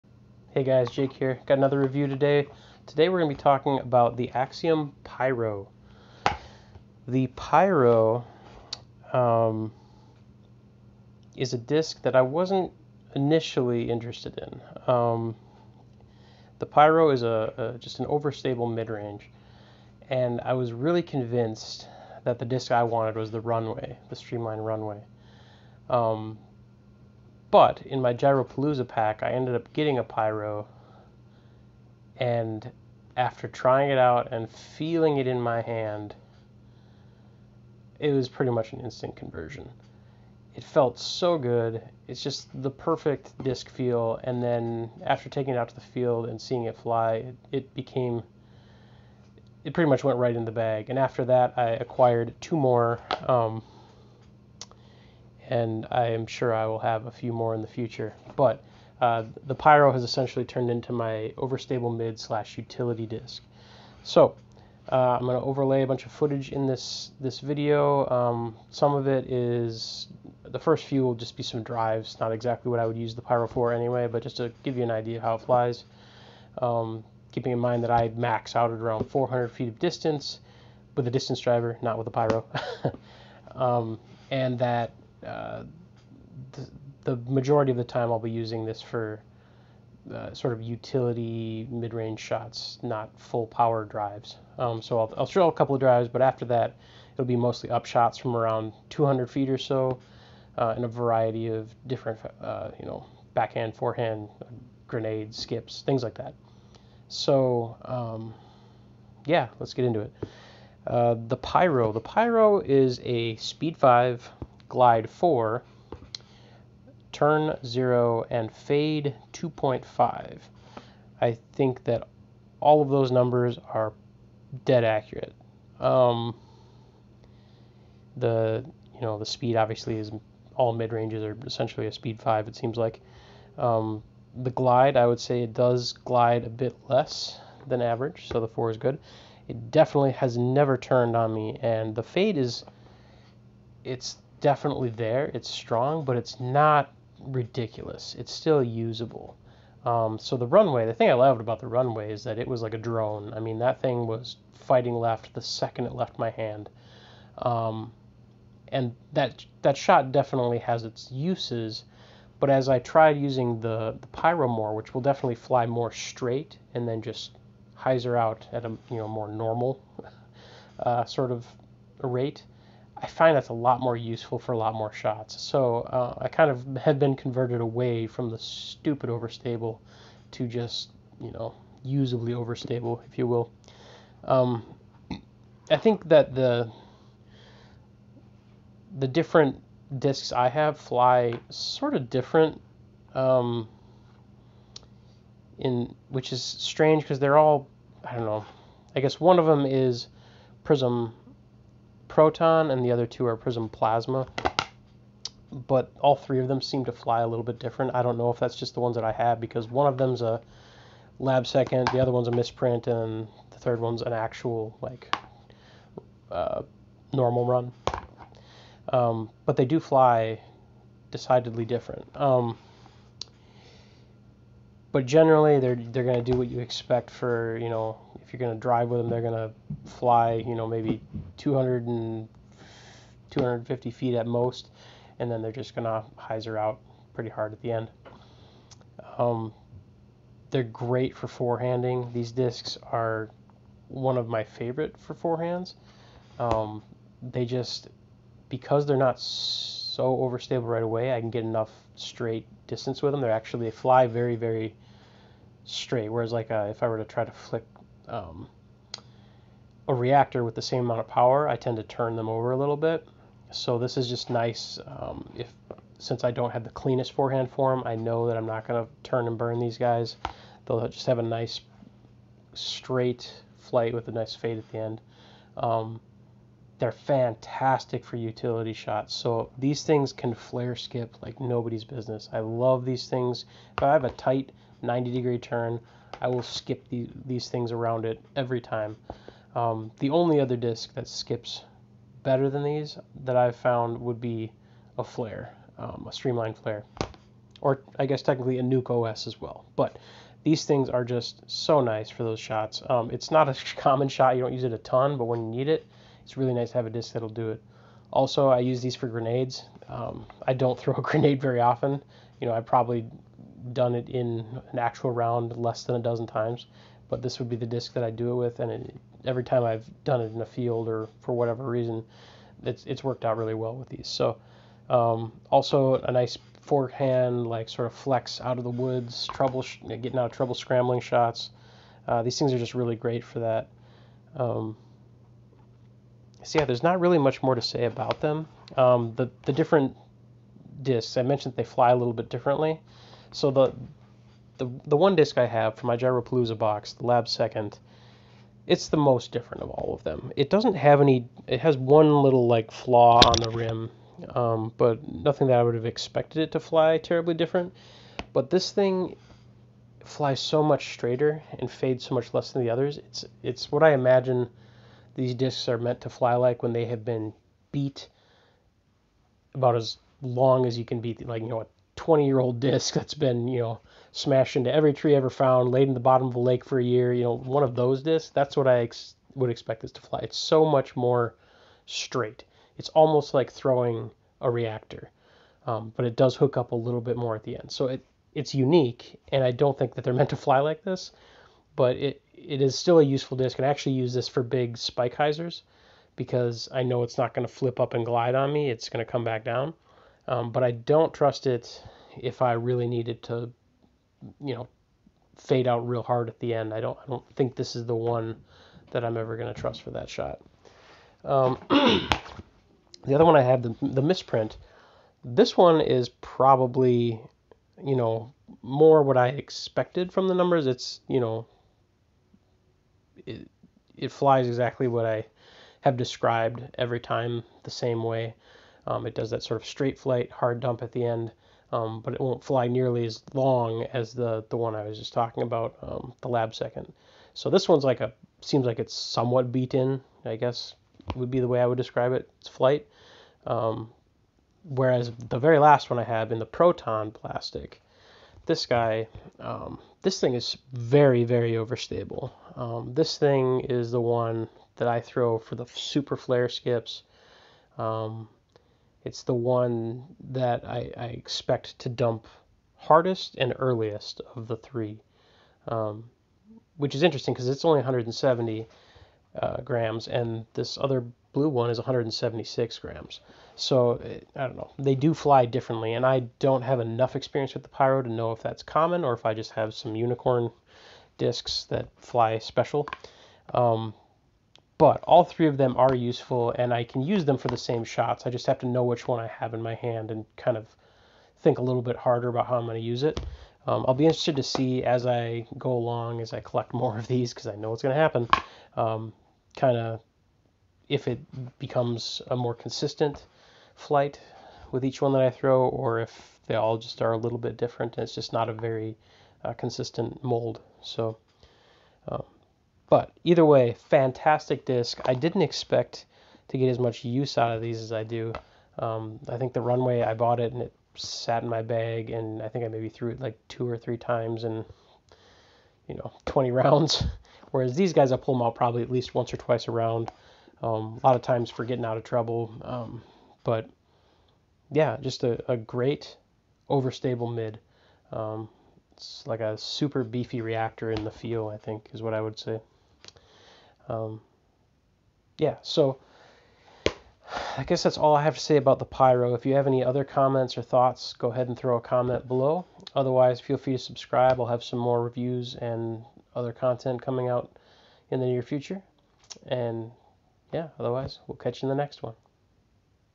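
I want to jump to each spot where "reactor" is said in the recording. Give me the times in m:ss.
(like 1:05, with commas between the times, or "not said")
4:19, 6:24, 9:00.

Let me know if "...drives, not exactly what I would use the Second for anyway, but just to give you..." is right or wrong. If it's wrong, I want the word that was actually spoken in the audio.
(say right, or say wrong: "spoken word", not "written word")
wrong: "Pyro", not "Second".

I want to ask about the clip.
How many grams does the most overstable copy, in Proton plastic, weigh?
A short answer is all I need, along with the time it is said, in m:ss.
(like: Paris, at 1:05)
170, at 7:47.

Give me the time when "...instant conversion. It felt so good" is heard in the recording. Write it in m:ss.
0:38.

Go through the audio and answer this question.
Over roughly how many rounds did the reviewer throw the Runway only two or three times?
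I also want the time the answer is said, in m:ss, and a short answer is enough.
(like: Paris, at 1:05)
20, at 8:46.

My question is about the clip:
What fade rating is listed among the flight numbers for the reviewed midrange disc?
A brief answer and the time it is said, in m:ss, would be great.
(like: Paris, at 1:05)
2.5, at 1:59.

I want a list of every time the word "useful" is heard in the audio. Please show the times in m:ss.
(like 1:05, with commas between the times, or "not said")
2:53, 6:33, 8:05.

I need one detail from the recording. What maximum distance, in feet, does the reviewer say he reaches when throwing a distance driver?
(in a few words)
400 feet.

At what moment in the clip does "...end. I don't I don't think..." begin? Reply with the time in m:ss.
6:46.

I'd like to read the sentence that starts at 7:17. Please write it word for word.
So this one's like a, seems like it's somewhat beaten, I guess would be the way I would describe it, its flight.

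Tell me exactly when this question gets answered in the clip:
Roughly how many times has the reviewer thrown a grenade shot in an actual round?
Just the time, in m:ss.
5:15.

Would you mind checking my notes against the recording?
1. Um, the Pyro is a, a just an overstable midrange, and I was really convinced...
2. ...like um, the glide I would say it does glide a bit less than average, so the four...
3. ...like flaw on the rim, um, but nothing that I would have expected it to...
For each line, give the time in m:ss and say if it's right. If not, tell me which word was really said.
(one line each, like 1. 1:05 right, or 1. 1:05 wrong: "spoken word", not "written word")
1. 0:14 right
2. 2:12 right
3. 5:52 right.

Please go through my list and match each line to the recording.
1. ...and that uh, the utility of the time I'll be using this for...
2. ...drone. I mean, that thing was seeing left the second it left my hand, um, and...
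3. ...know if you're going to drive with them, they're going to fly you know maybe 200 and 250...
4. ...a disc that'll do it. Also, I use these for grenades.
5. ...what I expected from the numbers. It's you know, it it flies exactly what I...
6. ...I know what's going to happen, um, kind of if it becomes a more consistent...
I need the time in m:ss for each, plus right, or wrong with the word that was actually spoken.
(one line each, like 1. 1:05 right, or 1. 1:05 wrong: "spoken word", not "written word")
1. 1:24 wrong: "majority", not "utility"
2. 2:32 wrong: "fighting", not "seeing"
3. 3:47 right
4. 5:06 right
5. 6:59 right
6. 8:17 right.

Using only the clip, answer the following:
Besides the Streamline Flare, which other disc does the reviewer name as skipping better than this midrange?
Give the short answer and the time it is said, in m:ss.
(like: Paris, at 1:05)
Nuke OS, at 4:58.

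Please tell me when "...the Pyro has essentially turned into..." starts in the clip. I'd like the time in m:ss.
0:59.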